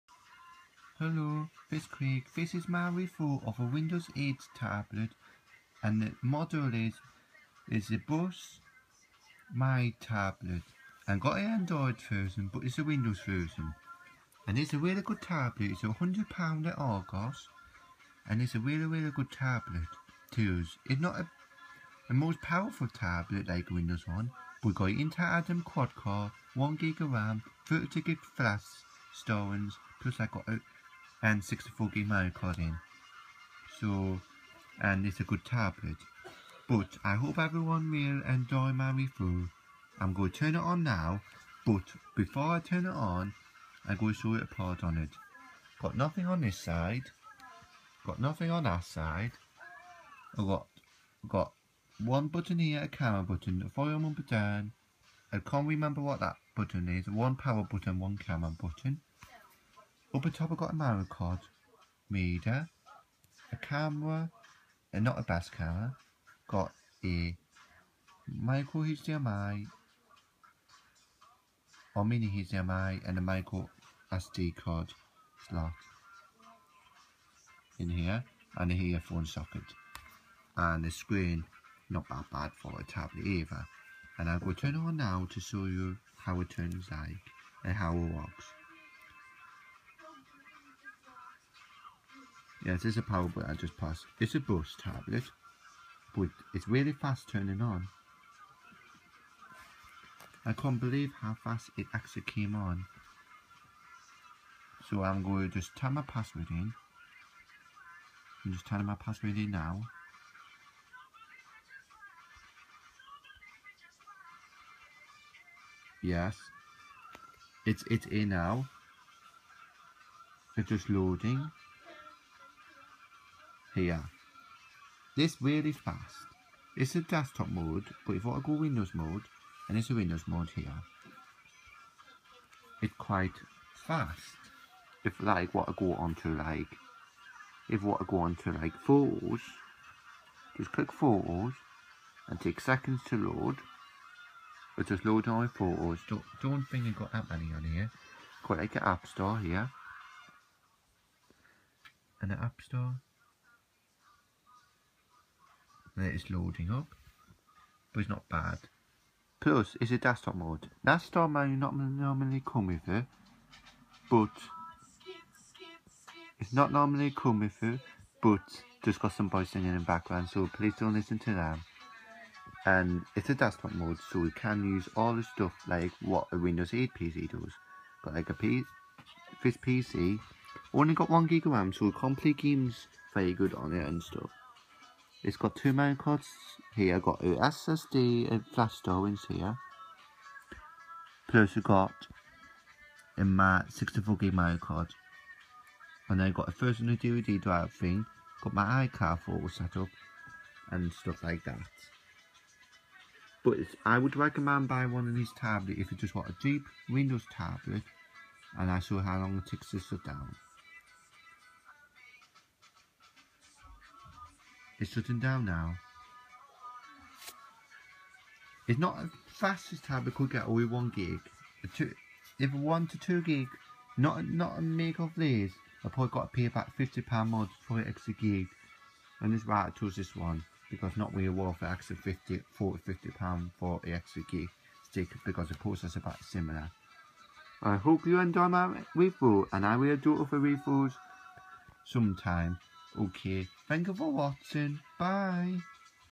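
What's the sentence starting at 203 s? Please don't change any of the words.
But I would recommend buying one of these tablets if you just want a cheap Windows tablet.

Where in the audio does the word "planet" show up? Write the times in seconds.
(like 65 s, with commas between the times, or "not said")
not said.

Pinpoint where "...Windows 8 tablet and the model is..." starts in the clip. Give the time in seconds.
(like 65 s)
3 s.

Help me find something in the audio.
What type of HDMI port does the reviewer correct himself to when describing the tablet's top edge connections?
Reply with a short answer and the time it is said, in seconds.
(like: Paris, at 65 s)
mini HDMI, at 72 s.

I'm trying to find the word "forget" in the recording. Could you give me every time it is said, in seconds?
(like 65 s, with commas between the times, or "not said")
not said.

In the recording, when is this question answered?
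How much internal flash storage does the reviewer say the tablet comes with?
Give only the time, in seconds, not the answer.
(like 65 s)
27 s.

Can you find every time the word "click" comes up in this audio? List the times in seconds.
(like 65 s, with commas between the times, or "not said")
140 s.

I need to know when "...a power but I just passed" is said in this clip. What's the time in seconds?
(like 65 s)
92 s.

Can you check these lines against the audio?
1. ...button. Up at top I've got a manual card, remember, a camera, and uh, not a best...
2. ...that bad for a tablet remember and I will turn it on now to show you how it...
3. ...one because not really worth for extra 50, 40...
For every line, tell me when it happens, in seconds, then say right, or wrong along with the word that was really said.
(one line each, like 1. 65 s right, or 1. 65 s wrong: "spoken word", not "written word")
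1. 58 s wrong: "reader", not "remember"
2. 82 s wrong: "either", not "remember"
3. 230 s right.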